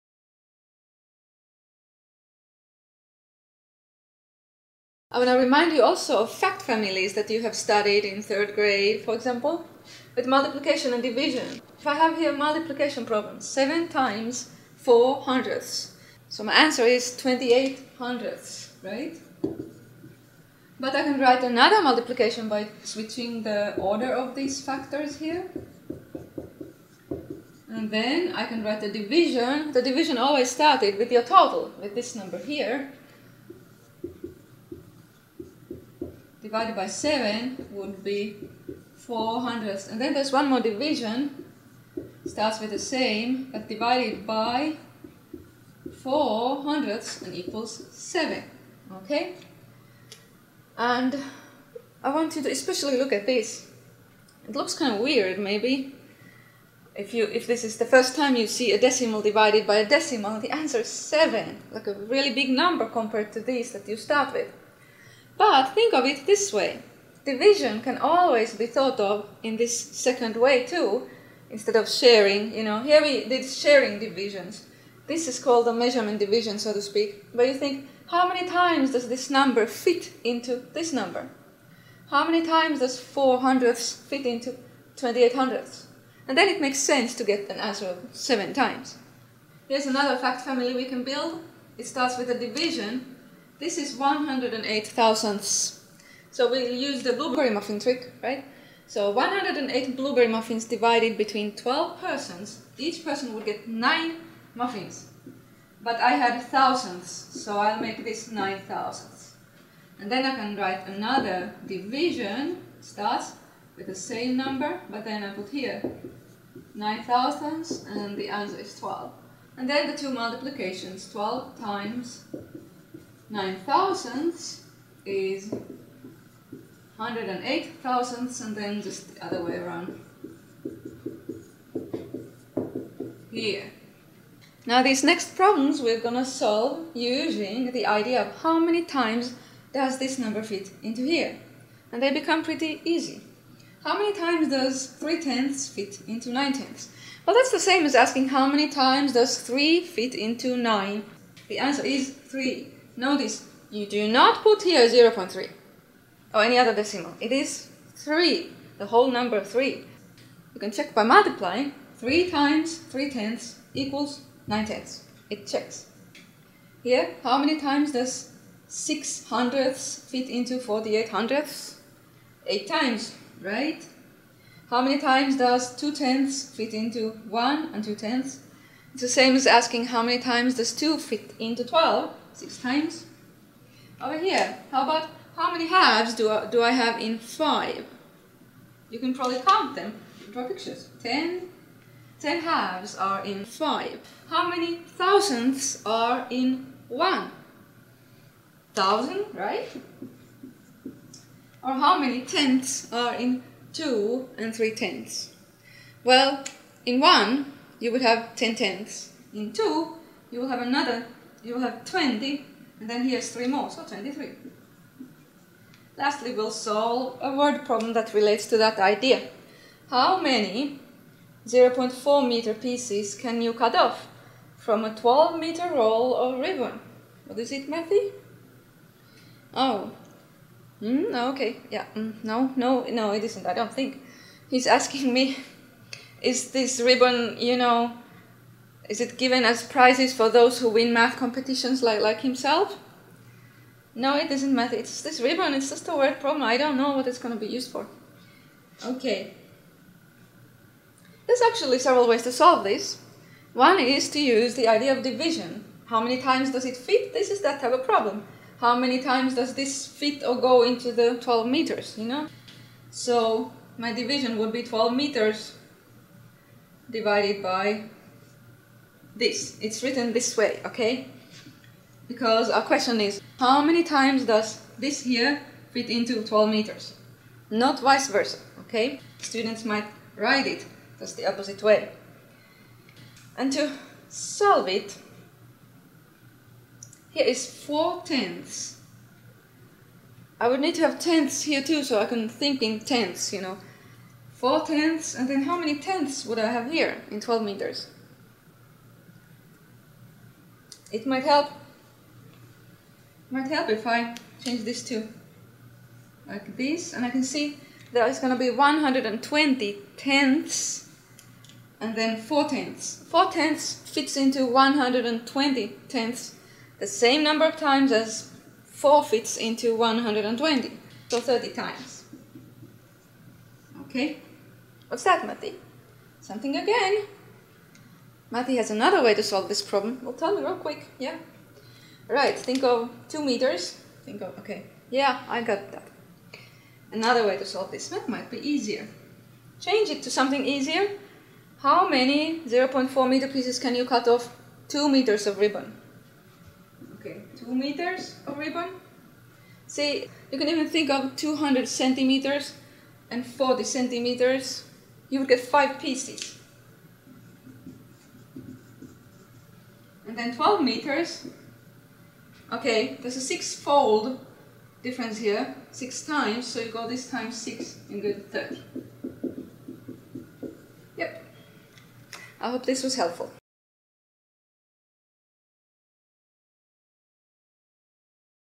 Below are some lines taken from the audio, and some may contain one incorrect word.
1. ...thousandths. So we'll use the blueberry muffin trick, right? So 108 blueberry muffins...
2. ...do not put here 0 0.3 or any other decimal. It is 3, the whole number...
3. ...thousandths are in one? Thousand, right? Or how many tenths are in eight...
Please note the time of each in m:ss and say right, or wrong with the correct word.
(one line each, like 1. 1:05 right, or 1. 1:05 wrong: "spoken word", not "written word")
1. 1:34 right
2. 2:33 right
3. 3:14 wrong: "two", not "eight".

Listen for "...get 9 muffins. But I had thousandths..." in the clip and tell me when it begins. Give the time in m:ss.
1:43.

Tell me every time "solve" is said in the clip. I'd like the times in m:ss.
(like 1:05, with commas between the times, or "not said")
2:16, 3:36, 4:12, 4:44, 5:29, 5:37.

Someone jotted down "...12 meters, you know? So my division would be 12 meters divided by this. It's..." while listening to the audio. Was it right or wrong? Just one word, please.
right.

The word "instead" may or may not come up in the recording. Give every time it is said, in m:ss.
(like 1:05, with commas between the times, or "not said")
1:11.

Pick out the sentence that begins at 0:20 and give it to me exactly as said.
But I can write another multiplication by switching the order of these factors here.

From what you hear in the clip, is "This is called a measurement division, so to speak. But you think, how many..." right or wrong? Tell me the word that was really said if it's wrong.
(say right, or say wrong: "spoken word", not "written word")
right.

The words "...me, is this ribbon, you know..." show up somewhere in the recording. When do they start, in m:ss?
3:55.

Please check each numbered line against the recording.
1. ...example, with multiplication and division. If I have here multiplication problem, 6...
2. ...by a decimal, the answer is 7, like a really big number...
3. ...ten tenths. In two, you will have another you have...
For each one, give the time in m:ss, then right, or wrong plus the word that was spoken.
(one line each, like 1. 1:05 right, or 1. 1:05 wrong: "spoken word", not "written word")
1. 0:09 wrong: "7", not "6"
2. 0:59 right
3. 3:28 right.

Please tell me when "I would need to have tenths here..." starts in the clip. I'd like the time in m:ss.
4:50.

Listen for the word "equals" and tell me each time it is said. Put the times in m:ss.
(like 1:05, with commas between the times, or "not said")
0:47, 2:43.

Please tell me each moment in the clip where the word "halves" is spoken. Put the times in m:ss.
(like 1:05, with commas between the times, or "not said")
3:05, 3:12.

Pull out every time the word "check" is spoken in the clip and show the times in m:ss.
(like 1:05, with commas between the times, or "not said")
2:40, 2:45.